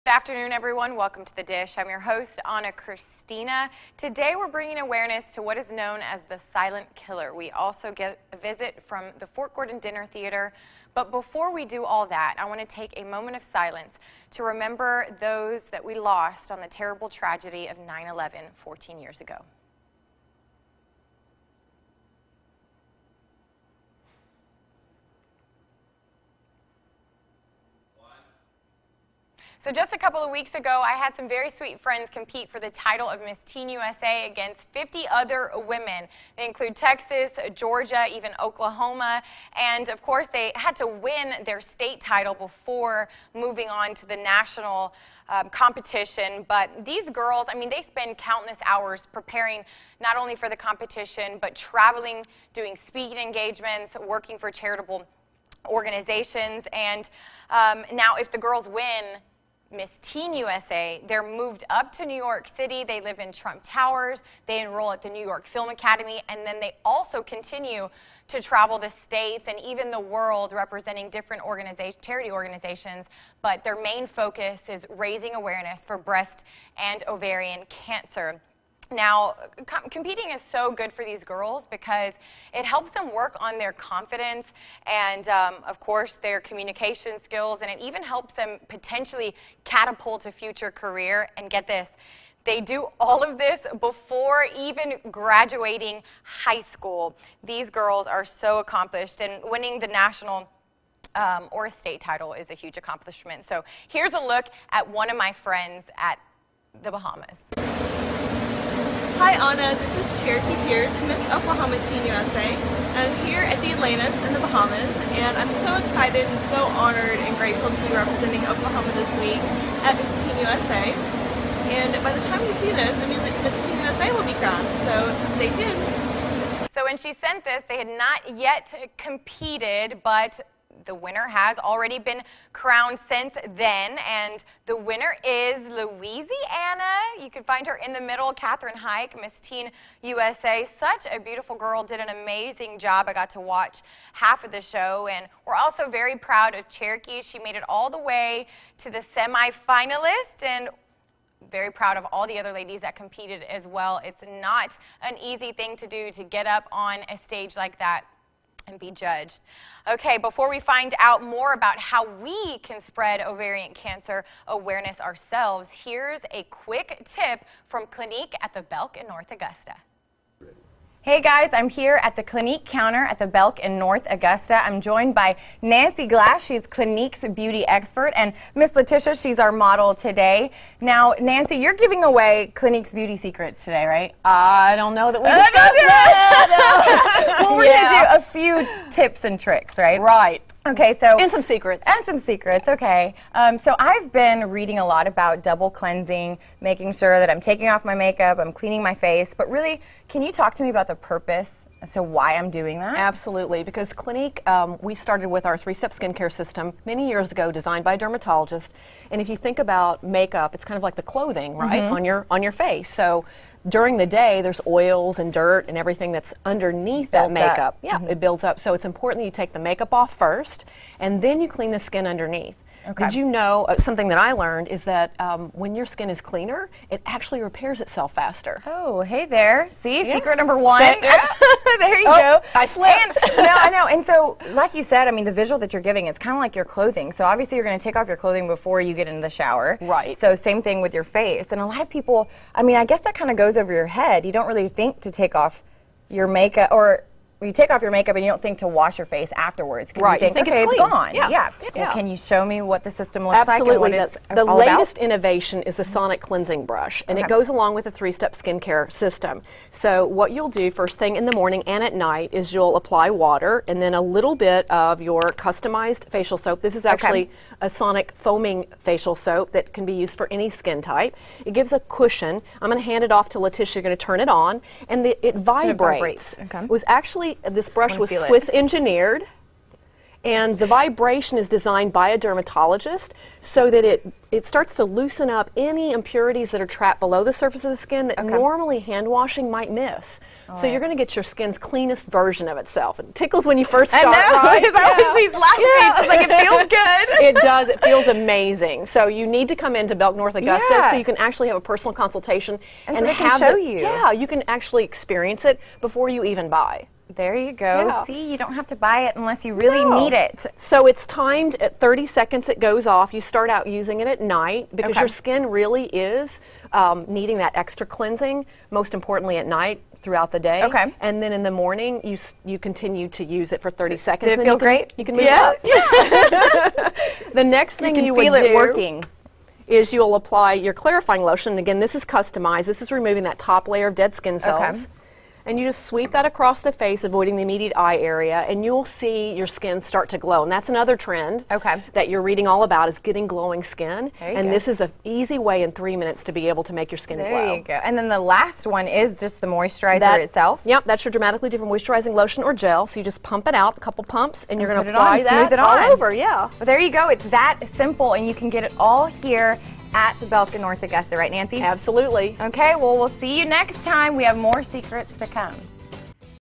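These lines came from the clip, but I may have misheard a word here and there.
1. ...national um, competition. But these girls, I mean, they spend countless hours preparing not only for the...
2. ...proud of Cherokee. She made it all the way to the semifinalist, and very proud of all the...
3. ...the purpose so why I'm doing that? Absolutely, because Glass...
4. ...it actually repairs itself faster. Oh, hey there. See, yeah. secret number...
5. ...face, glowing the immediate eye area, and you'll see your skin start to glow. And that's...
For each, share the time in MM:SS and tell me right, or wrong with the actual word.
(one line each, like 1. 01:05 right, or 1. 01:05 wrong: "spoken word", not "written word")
1. 00:44 right
2. 02:26 right
3. 03:20 wrong: "Clinique", not "Glass"
4. 03:46 right
5. 05:36 wrong: "avoiding", not "glowing".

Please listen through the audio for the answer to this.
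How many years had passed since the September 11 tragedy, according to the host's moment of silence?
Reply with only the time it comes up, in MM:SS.
00:18.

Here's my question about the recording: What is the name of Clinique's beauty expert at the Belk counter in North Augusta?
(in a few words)
Nancy Glass.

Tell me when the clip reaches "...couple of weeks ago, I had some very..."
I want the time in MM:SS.
00:29.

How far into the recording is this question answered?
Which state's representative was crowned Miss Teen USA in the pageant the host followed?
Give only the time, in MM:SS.
02:15.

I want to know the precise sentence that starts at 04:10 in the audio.
you think, you think okay, it's, it's gone.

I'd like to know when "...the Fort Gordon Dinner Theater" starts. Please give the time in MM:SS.
00:09.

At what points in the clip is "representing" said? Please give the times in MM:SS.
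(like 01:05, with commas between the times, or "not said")
01:10, 01:57.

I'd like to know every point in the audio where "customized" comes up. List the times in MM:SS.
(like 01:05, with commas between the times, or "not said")
04:25, 05:32.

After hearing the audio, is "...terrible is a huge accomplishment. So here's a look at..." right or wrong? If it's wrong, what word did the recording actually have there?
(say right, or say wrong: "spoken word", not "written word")
wrong: "title", not "terrible".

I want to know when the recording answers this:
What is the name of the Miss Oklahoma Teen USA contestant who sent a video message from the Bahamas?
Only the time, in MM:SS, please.
01:50.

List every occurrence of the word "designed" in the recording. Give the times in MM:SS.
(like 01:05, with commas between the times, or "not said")
03:27, 04:41.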